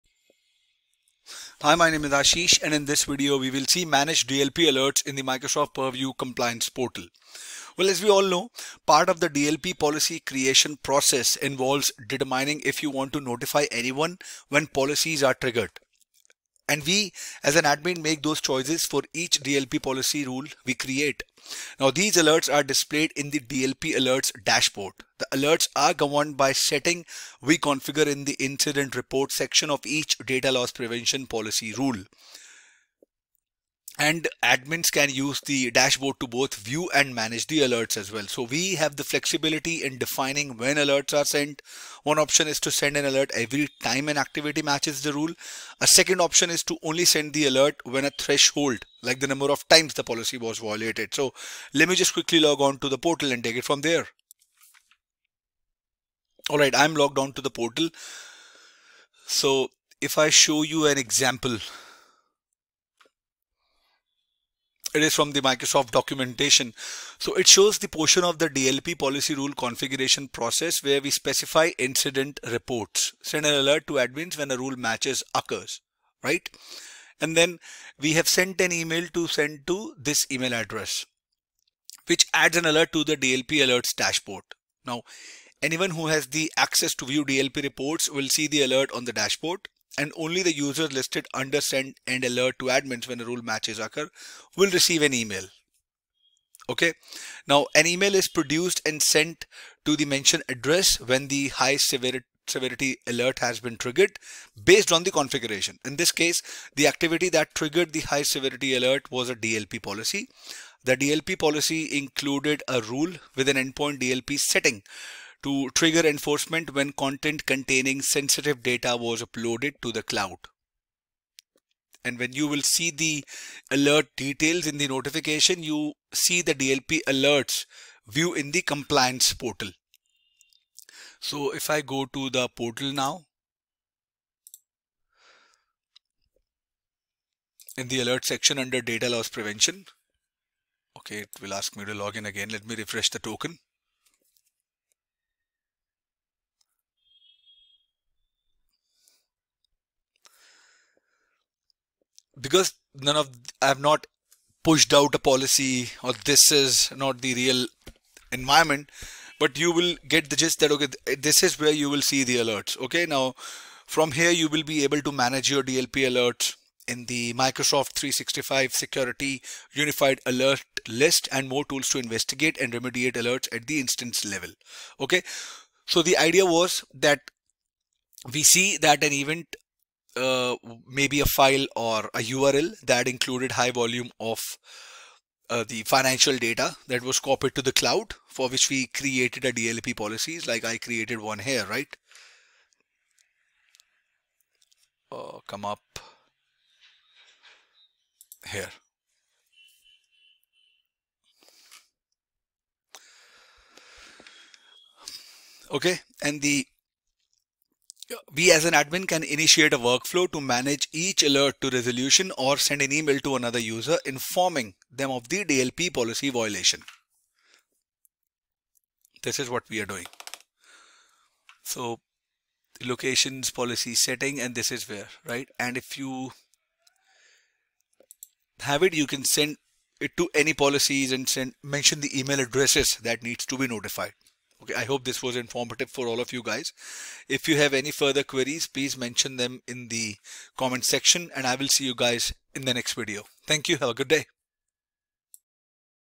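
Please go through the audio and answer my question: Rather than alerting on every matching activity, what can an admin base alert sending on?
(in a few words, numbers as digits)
a threshold.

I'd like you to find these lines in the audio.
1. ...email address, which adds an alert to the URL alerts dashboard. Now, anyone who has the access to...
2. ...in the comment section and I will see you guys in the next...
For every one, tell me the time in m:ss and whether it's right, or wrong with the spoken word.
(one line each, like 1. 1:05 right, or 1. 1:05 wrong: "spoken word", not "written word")
1. 1:20 wrong: "DLP", not "URL"
2. 3:59 right.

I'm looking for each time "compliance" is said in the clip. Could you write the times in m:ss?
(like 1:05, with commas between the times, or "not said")
0:06, 2:08.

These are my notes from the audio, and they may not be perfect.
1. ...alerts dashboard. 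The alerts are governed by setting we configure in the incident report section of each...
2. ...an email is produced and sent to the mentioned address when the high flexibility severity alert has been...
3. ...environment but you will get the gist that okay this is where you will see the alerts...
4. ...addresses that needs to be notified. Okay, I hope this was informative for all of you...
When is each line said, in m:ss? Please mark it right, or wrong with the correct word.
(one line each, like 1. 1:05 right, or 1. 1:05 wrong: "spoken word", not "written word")
1. 0:23 right
2. 1:37 wrong: "severity", not "flexibility"
3. 2:38 right
4. 3:52 right.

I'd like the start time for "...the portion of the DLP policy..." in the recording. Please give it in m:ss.
1:07.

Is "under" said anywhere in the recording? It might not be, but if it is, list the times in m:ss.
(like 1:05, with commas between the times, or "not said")
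1:31, 2:18.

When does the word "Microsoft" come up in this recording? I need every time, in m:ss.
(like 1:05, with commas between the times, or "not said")
0:05, 1:05, 2:47.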